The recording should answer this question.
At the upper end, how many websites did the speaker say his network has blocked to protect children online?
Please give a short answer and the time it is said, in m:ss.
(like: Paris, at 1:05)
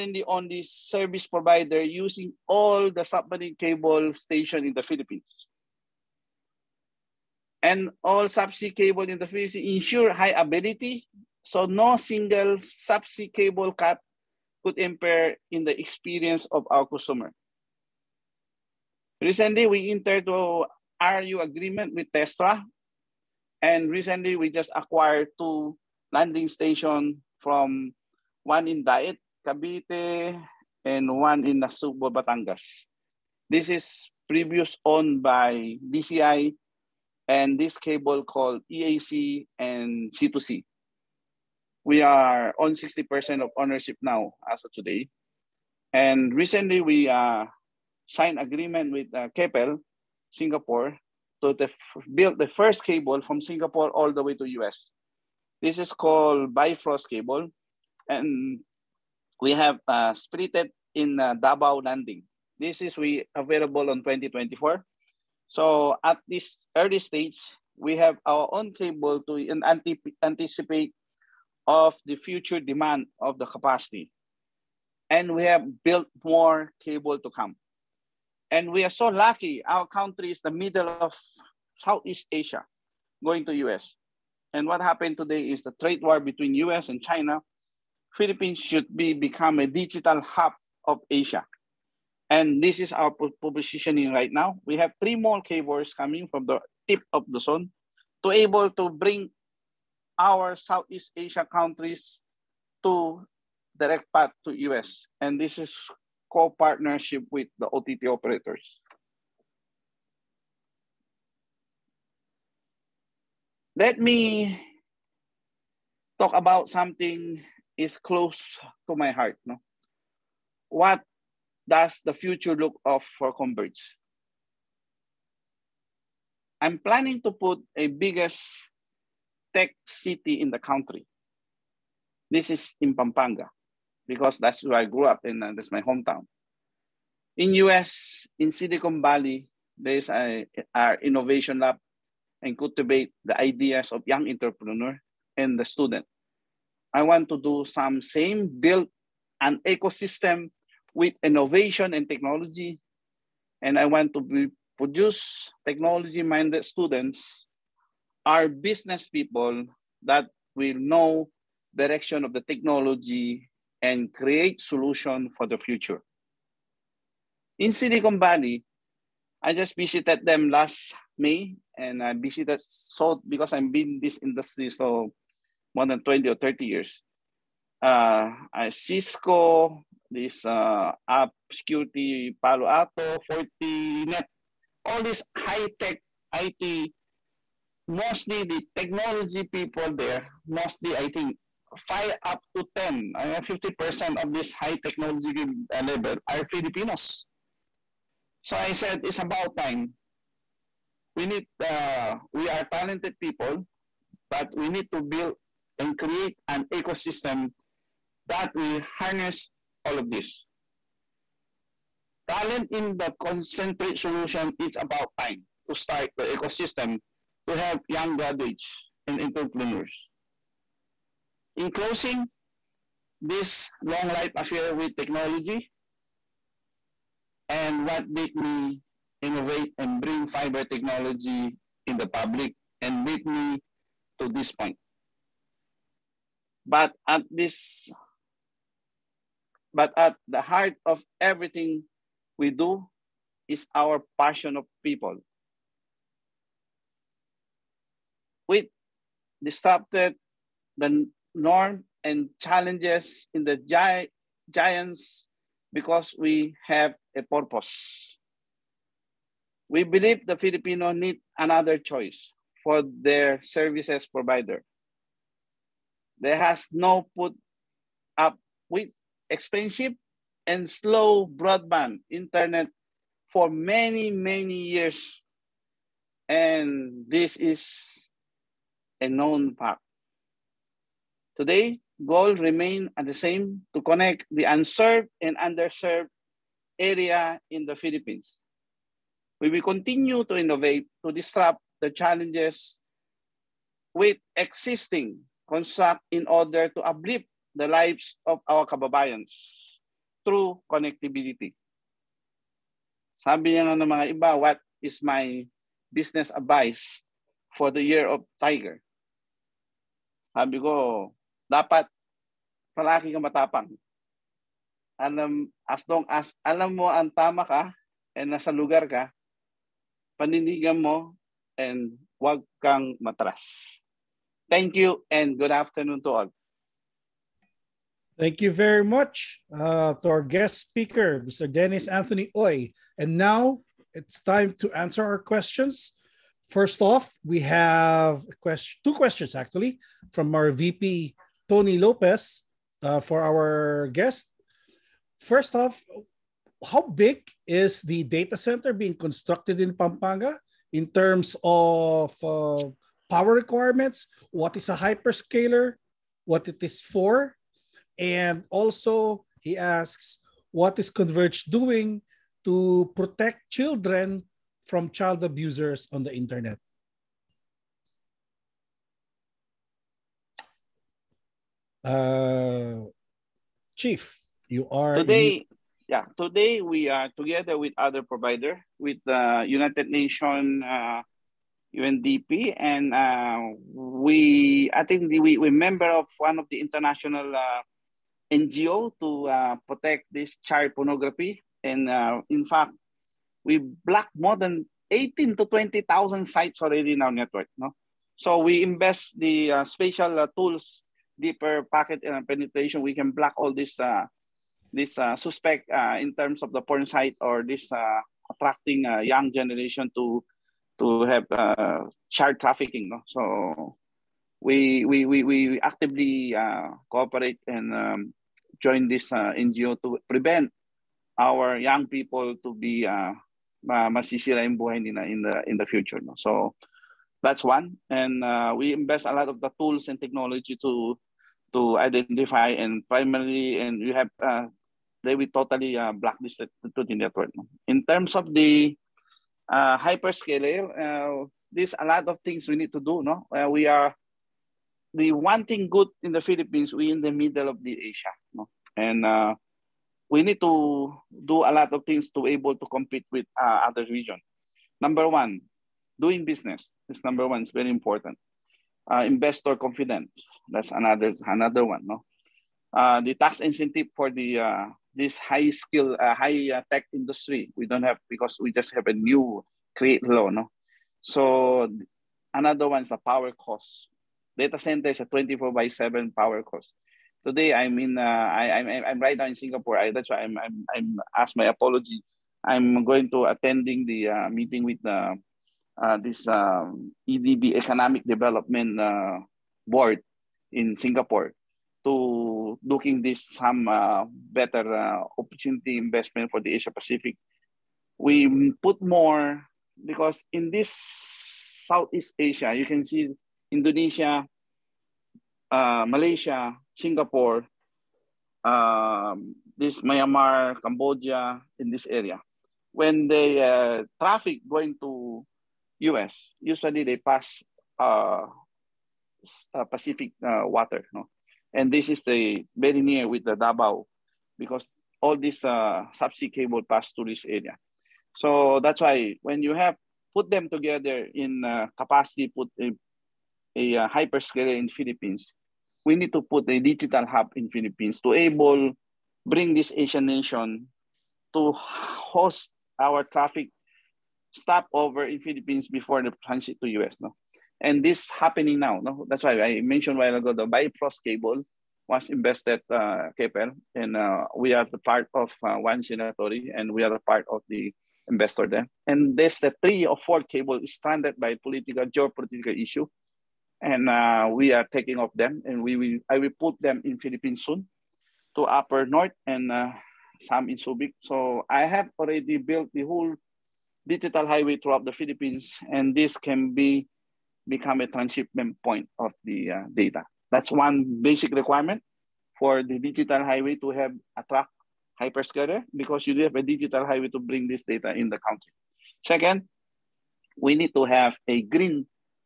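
20,000, at 6:35.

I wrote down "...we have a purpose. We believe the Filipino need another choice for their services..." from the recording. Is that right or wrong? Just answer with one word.
right.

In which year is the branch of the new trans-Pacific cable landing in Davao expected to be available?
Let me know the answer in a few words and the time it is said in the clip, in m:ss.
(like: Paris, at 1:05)
2024, at 1:04.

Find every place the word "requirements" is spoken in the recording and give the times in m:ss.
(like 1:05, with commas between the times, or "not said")
5:53, 9:41.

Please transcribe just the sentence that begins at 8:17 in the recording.
We put more because in this Southeast Asia, you can see Indonesia, uh, Malaysia, Singapore, um, this Myanmar, Cambodia, in this area.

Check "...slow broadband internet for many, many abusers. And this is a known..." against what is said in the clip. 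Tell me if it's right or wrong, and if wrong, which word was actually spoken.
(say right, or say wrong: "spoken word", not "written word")
wrong: "years", not "abusers".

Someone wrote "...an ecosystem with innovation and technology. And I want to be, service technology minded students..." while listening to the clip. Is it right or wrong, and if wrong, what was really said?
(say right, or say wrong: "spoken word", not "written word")
wrong: "produce", not "service".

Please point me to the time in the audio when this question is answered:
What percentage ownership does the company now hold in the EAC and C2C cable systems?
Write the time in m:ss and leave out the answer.
0:42.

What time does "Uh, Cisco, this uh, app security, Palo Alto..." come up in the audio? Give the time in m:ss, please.
2:57.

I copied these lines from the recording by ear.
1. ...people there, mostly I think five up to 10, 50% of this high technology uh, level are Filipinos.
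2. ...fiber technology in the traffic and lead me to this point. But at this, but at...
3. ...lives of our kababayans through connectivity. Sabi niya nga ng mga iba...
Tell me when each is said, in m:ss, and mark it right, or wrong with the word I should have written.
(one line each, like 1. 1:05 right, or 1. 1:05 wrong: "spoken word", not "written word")
1. 3:09 right
2. 3:50 wrong: "public", not "traffic"
3. 4:57 right.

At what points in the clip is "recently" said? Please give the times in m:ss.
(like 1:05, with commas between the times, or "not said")
0:19, 0:23, 0:46.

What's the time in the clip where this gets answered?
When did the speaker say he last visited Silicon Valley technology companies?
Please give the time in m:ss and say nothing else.
2:50.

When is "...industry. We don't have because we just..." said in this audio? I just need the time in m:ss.
7:46.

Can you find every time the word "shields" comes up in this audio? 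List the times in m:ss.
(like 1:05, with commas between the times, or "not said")
not said.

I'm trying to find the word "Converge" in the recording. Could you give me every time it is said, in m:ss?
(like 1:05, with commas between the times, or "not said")
2:03, 6:00.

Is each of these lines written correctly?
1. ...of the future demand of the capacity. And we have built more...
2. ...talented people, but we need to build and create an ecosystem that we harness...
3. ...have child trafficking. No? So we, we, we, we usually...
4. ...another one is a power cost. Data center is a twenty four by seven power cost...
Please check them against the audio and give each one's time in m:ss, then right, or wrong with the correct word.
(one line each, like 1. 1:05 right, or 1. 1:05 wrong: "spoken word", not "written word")
1. 1:11 right
2. 3:22 right
3. 6:51 wrong: "actively", not "usually"
4. 7:52 right.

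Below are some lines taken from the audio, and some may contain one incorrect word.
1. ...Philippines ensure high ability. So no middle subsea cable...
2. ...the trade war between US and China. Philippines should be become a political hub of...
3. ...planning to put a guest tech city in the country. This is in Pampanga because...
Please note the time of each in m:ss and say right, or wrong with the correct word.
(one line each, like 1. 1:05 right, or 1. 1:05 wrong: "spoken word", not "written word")
1. 0:09 wrong: "single", not "middle"
2. 1:25 wrong: "digital", not "political"
3. 2:06 wrong: "biggest", not "guest".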